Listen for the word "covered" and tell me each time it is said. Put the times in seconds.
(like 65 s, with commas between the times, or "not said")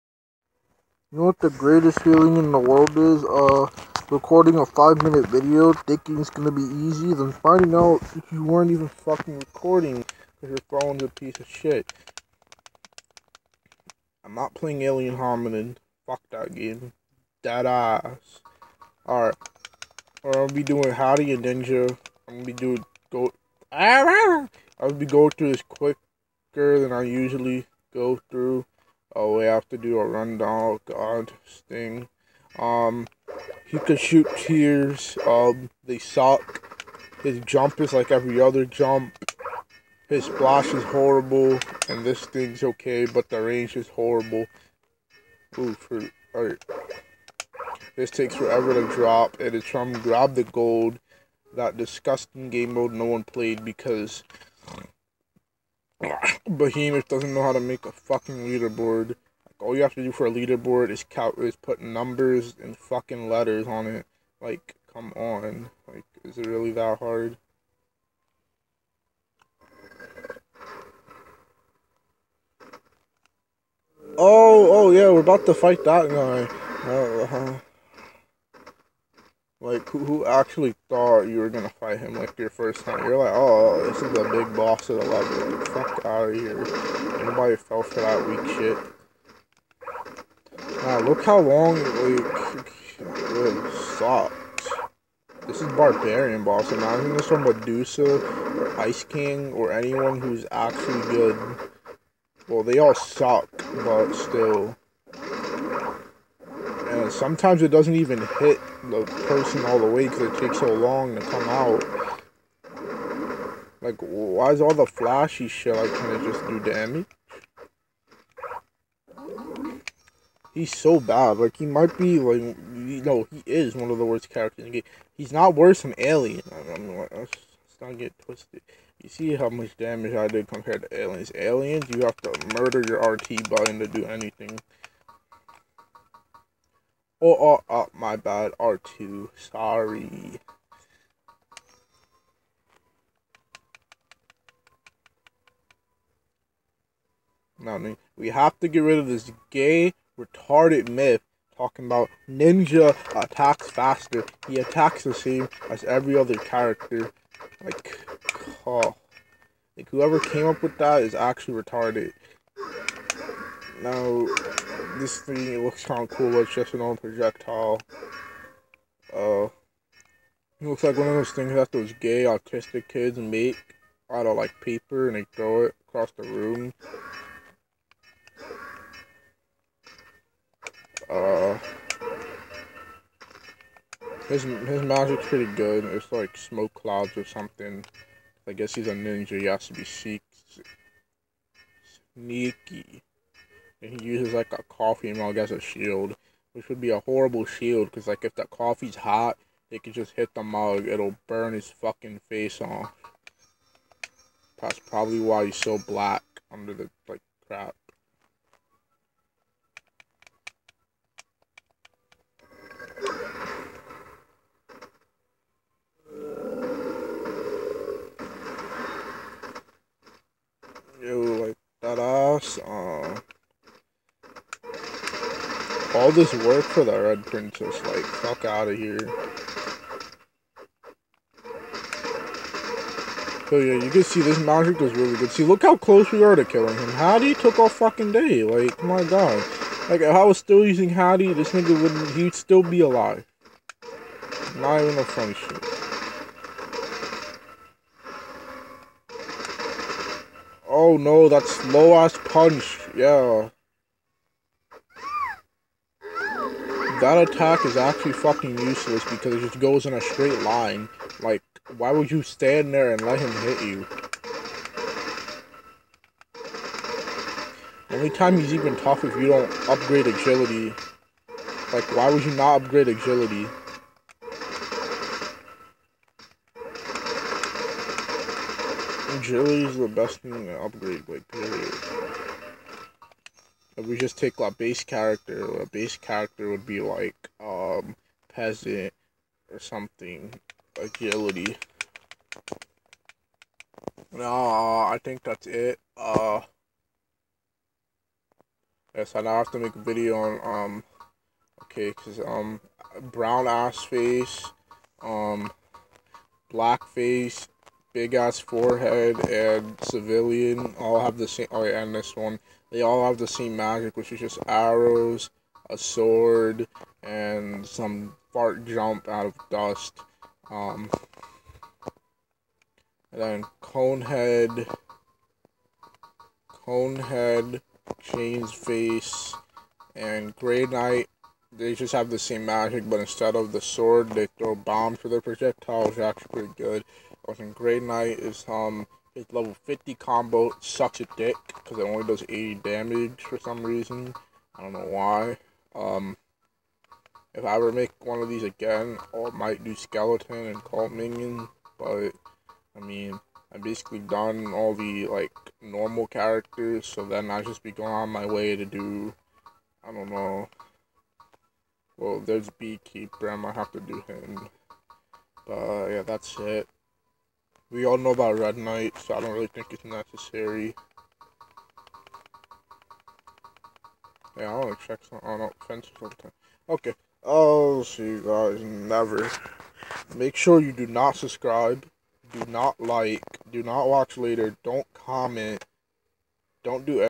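not said.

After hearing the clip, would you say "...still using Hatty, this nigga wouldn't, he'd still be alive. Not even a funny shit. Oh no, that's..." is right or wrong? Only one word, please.
right.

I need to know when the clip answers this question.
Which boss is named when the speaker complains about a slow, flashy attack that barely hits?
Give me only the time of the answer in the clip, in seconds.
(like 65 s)
95 s.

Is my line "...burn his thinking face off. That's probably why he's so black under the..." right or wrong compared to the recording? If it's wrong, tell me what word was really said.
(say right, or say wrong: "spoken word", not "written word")
wrong: "fucking", not "thinking".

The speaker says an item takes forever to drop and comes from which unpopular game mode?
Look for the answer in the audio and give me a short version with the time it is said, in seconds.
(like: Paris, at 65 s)
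Grab the Gold, at 49 s.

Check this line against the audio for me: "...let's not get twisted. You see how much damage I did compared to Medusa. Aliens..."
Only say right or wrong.
wrong.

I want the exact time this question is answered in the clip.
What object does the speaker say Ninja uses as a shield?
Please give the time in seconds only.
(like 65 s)
194 s.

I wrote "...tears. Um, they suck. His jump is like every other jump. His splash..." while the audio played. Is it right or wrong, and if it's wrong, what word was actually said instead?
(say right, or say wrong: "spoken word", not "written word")
right.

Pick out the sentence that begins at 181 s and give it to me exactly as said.
Uh, his his magic's pretty good.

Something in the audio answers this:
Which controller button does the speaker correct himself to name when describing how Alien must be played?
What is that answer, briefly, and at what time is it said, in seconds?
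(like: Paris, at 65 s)
R2, at 138 s.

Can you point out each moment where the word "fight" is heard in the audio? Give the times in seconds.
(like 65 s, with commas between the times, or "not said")
75 s, 81 s.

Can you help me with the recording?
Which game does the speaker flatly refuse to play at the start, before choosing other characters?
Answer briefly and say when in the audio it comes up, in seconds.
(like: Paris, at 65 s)
Alien Hominid, at 14 s.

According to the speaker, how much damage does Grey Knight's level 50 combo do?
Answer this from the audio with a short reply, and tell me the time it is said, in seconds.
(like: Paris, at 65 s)
80, at 342 s.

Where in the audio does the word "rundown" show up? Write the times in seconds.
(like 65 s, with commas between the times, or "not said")
30 s.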